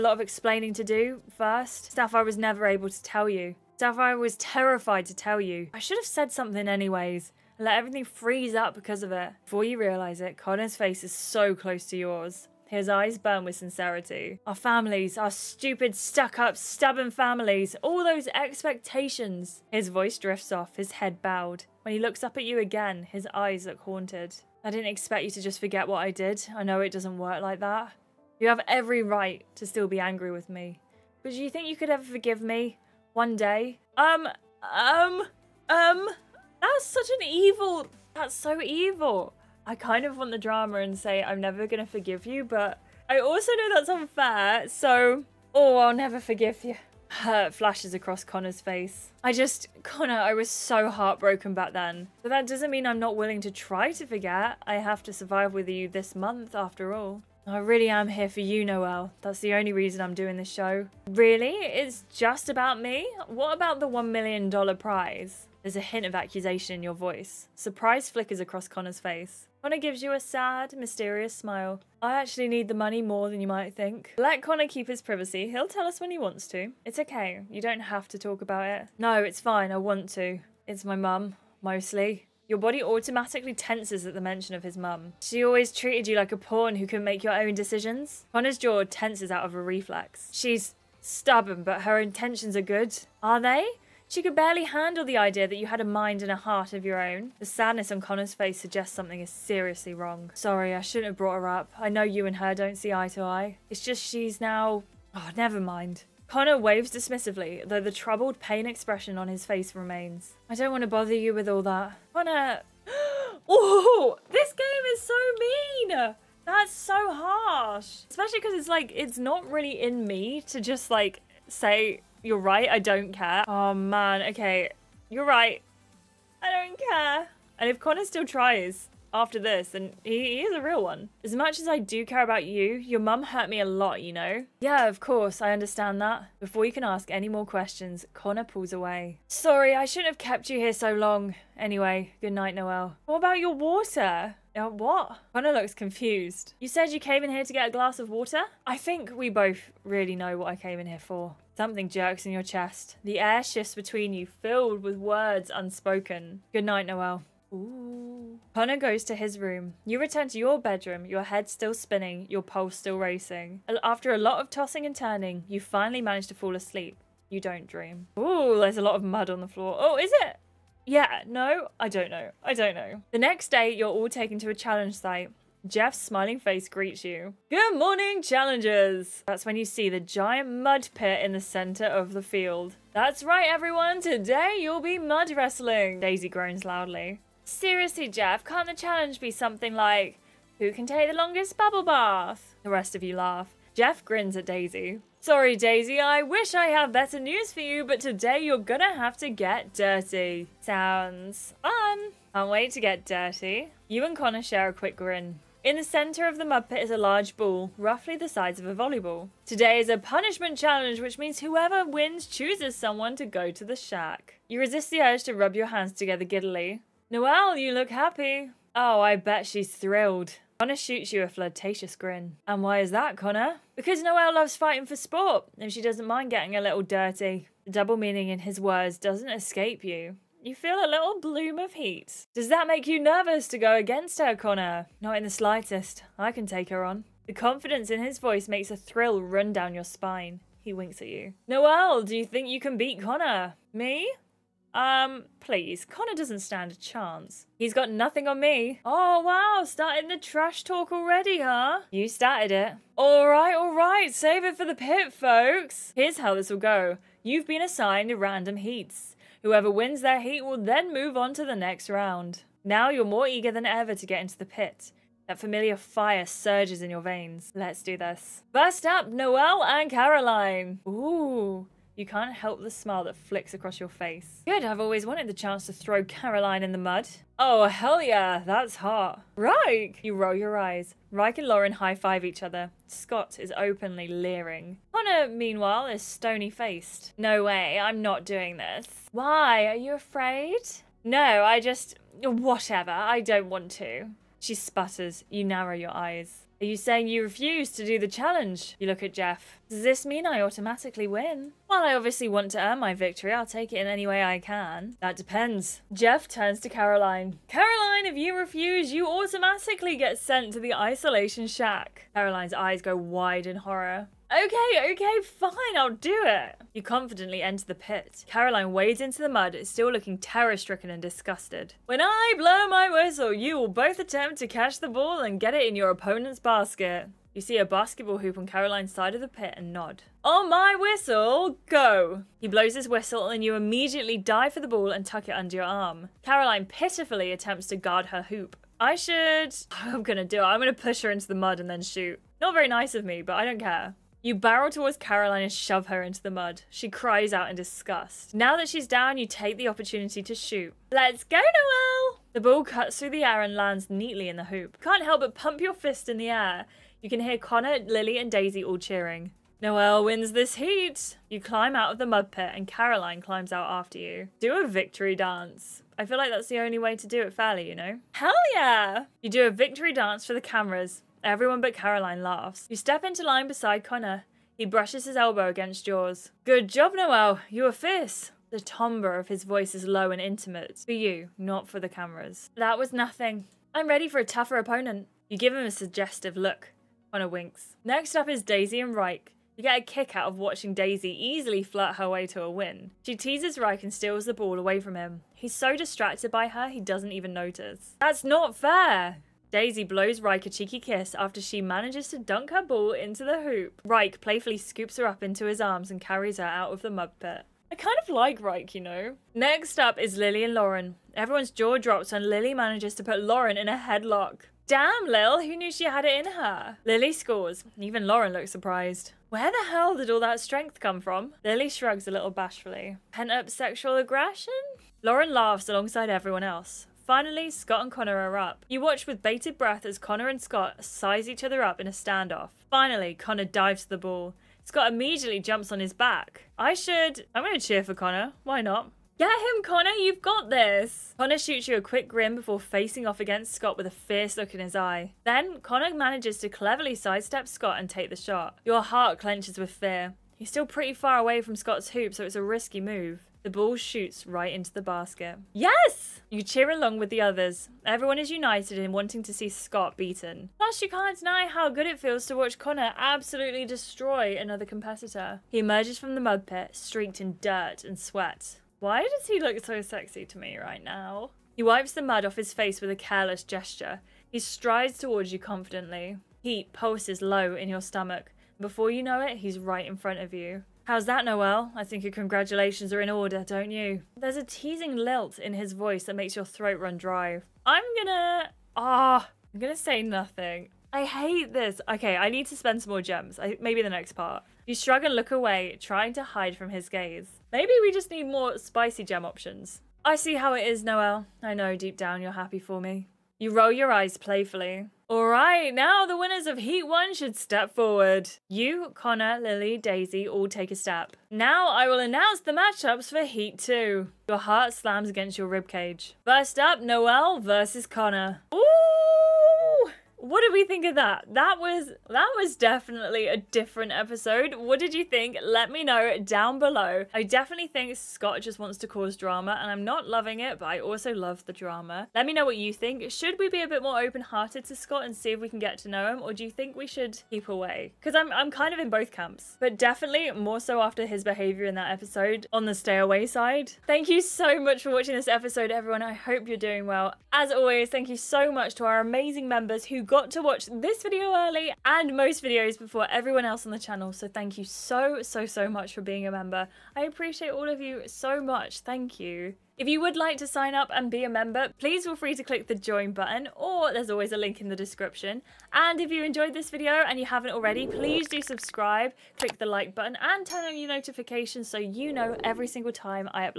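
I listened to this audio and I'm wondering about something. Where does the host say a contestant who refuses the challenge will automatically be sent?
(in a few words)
The isolation shack.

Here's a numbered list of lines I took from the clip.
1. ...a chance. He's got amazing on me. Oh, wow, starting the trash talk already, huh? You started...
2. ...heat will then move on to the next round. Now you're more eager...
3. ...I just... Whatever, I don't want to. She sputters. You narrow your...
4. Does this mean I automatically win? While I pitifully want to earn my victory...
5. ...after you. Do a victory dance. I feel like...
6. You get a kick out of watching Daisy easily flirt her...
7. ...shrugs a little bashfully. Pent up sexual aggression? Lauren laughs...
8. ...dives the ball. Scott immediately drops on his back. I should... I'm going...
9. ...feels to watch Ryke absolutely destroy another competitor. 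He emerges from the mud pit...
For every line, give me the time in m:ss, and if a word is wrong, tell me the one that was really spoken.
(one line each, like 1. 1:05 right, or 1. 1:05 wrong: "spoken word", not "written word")
1. 4:06 wrong: "nothing", not "amazing"
2. 4:20 right
3. 4:51 right
4. 4:59 wrong: "obviously", not "pitifully"
5. 6:03 right
6. 6:29 right
7. 7:01 right
8. 7:13 wrong: "jumps", not "drops"
9. 7:41 wrong: "Connor", not "Ryke".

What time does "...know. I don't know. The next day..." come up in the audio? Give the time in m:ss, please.
2:52.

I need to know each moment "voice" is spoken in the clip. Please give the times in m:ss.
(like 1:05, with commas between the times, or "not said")
0:19, 1:06, 3:58, 6:19, 8:05.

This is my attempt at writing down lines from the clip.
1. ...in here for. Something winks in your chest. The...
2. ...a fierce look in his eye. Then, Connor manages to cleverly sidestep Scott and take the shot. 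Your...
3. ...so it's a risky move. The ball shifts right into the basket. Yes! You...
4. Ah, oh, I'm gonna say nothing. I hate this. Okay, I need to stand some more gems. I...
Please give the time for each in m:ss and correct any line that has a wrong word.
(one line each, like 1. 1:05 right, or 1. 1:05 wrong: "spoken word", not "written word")
1. 2:30 wrong: "jerks", not "winks"
2. 7:23 right
3. 7:32 wrong: "shoots", not "shifts"
4. 8:08 wrong: "spend", not "stand".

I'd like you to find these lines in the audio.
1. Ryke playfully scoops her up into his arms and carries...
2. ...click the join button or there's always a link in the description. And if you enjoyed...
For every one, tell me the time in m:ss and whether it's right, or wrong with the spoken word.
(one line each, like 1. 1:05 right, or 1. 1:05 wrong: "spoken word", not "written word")
1. 6:43 right
2. 9:22 right.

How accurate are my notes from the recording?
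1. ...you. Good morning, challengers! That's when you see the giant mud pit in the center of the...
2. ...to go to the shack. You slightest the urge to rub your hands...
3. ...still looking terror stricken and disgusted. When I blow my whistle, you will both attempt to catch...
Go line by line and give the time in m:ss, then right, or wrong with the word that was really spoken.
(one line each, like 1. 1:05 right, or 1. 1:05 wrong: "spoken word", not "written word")
1. 2:57 right
2. 3:33 wrong: "resist", not "slightest"
3. 5:19 right.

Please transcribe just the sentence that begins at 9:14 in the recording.
So thank you so, so, so much for being a member.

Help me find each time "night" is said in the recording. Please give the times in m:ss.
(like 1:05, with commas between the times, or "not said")
2:22, 2:36.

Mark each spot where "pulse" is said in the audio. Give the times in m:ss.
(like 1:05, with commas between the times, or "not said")
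2:42, 7:56.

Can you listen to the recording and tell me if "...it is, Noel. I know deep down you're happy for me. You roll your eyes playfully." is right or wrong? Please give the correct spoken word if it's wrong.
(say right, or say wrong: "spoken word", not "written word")
right.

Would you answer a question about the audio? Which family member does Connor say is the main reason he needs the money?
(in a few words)
His mum.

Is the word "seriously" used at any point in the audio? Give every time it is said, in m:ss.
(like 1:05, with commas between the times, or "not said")
1:39, 3:07.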